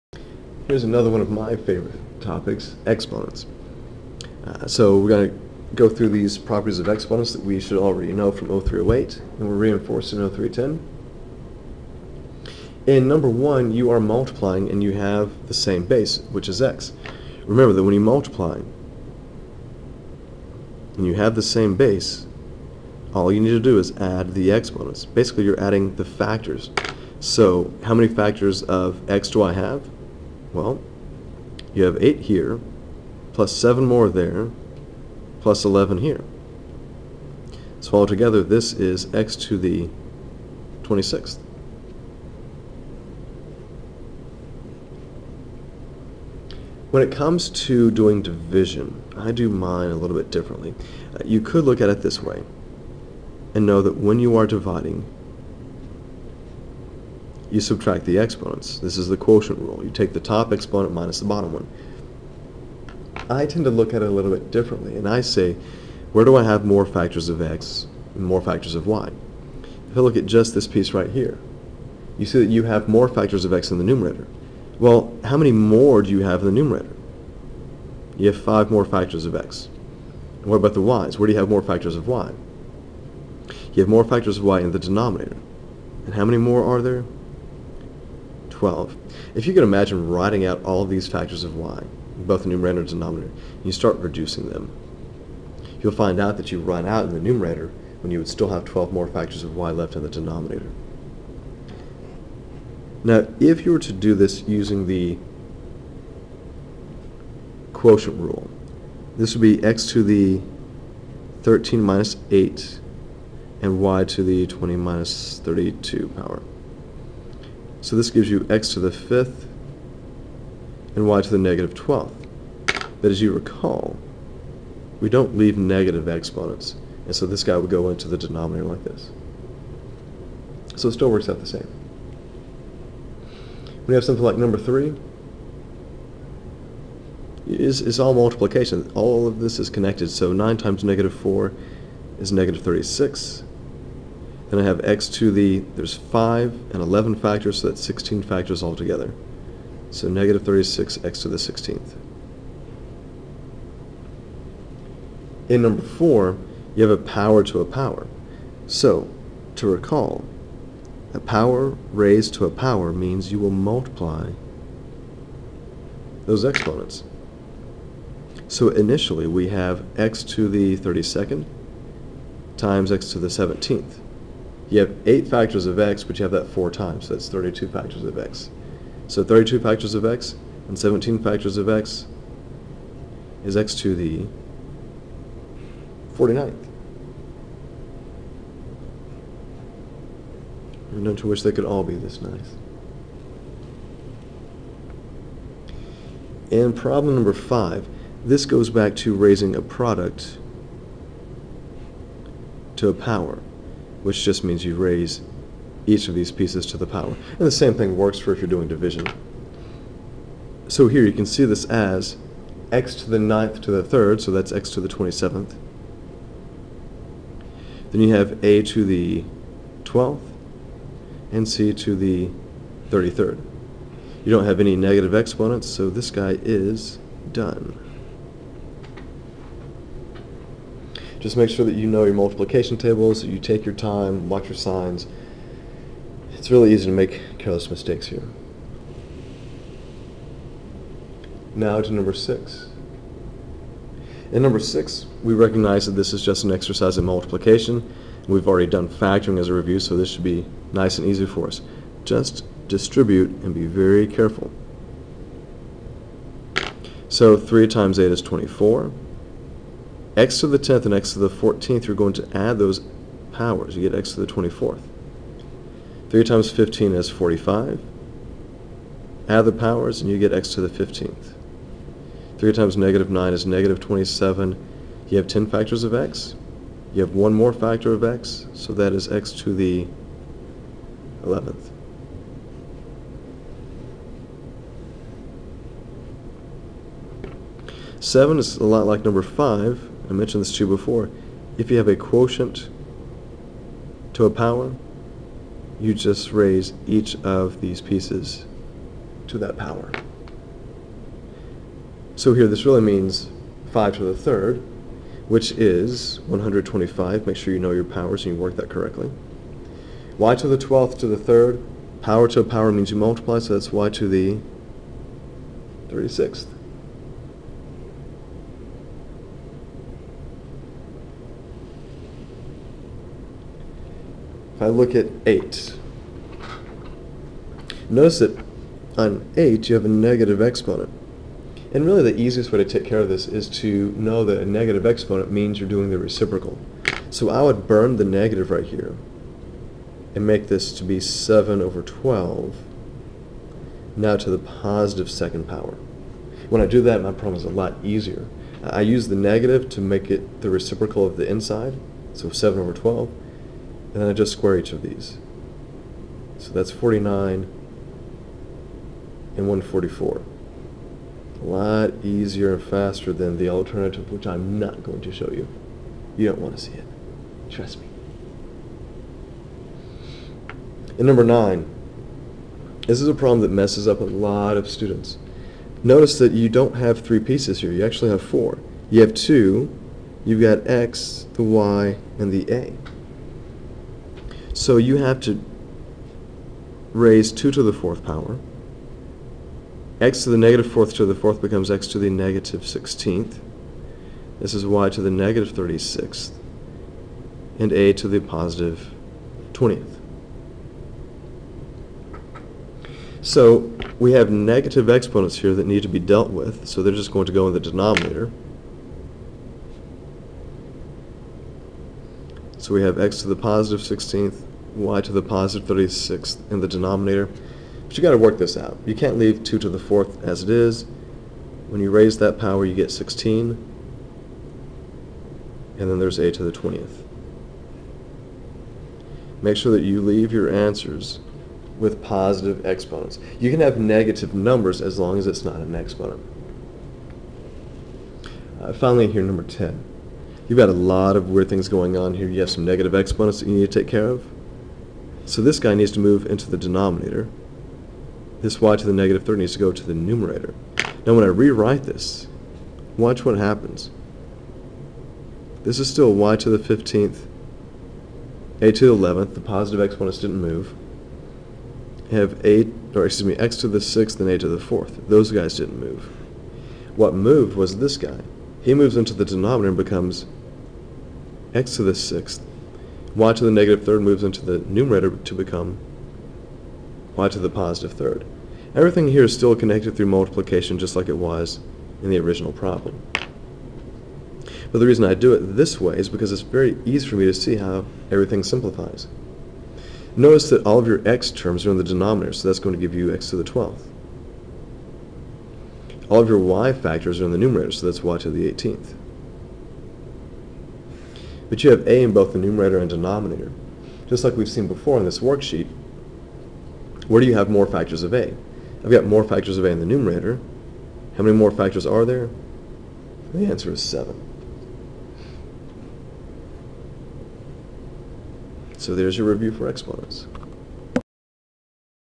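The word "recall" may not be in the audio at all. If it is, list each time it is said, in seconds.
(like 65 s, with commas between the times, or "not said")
123 s, 159 s.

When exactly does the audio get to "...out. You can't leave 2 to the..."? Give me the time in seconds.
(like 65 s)
418 s.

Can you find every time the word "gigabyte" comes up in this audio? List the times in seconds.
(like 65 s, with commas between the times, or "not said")
not said.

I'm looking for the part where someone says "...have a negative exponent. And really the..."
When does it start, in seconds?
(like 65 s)
329 s.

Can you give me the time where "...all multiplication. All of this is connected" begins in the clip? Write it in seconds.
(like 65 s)
137 s.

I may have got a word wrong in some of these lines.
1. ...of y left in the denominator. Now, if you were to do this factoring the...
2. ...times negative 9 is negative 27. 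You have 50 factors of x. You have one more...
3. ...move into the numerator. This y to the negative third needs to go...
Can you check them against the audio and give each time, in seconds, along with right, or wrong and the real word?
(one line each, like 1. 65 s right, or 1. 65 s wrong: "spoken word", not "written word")
1. 99 s wrong: "using", not "factoring"
2. 272 s wrong: "10", not "50"
3. 445 s wrong: "denominator", not "numerator".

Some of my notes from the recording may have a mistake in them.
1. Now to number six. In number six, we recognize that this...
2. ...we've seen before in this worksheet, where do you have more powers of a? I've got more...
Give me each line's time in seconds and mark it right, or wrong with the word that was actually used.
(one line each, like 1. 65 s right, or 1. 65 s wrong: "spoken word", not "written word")
1. 241 s right
2. 504 s wrong: "factors", not "powers".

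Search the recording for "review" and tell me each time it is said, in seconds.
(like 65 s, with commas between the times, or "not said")
249 s, 519 s.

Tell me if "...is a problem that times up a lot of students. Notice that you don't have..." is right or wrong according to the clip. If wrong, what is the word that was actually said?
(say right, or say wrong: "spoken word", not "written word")
wrong: "messes", not "times".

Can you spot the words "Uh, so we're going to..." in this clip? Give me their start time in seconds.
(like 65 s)
4 s.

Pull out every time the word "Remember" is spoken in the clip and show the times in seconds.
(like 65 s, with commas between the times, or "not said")
17 s.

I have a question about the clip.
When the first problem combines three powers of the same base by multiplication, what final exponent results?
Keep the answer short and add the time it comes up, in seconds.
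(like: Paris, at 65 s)
x^26, at 39 s.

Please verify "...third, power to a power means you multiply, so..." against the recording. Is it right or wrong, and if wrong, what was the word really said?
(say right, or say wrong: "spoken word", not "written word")
right.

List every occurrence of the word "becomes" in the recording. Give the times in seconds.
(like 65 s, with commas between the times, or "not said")
391 s, 469 s, 475 s.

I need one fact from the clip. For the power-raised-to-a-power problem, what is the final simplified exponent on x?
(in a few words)
49.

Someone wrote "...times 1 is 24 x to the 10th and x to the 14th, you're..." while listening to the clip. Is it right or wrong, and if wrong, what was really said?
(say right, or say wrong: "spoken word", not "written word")
wrong: "8", not "1".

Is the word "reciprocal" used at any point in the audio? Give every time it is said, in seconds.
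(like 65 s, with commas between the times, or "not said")
335 s, 350 s.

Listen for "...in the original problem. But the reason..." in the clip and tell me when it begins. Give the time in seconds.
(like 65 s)
482 s.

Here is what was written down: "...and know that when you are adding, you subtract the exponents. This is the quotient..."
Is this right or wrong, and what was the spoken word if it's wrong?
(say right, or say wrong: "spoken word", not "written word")
wrong: "dividing", not "adding".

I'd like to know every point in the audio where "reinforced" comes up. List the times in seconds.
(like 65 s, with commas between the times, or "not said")
9 s.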